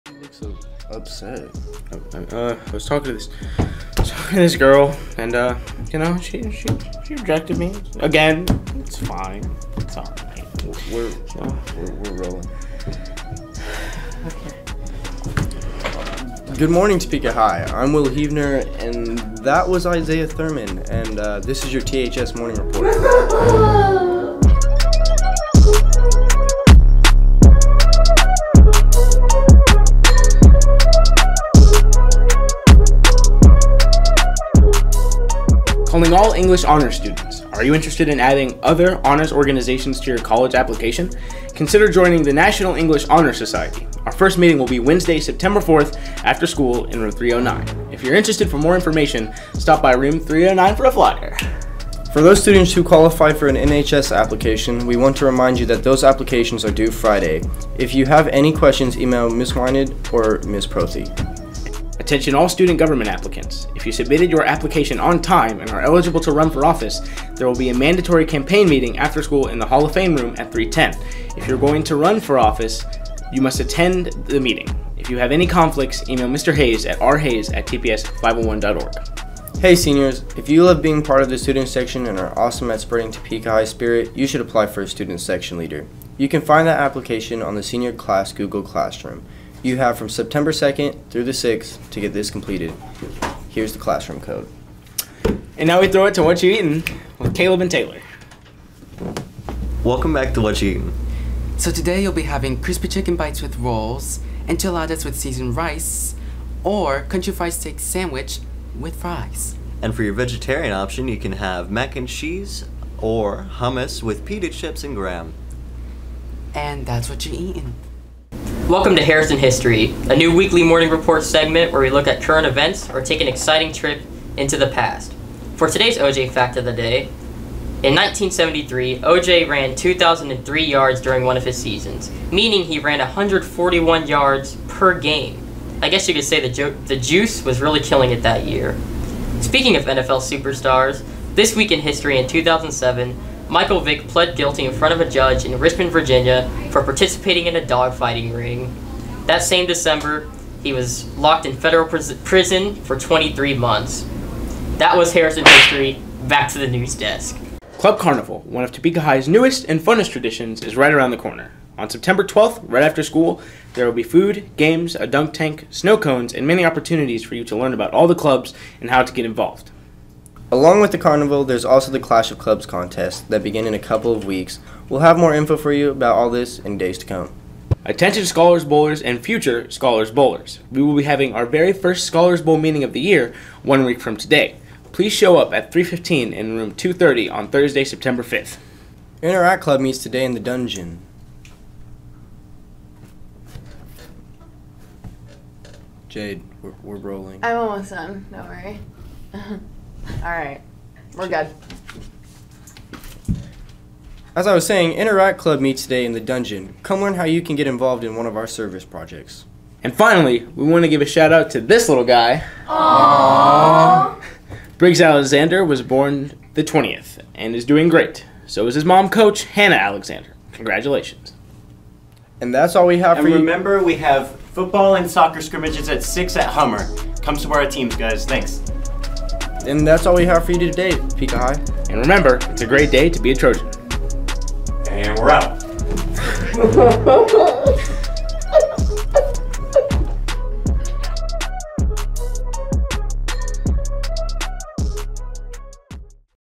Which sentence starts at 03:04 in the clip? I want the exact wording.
Please show up at 3:15 in room 230 on Thursday, September 5th.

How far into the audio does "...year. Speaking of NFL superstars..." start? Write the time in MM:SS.
02:18.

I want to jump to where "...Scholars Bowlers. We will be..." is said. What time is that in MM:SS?
02:59.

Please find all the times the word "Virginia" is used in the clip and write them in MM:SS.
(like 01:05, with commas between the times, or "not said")
02:25.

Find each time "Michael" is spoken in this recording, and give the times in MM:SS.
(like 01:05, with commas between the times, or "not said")
02:23.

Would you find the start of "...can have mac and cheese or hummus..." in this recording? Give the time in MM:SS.
01:51.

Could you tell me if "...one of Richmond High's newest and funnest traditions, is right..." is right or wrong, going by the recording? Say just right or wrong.
wrong.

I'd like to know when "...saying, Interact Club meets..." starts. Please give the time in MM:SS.
03:24.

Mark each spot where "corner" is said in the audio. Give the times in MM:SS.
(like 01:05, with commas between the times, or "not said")
02:41.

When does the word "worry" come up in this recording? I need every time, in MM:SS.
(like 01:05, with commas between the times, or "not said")
03:18.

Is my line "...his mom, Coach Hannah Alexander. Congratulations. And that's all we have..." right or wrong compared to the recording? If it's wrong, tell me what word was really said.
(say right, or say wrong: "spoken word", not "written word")
right.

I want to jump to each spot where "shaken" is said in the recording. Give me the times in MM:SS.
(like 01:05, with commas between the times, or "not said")
not said.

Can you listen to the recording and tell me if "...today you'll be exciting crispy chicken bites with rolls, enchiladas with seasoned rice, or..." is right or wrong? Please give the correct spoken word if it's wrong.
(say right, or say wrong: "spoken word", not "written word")
wrong: "having", not "exciting".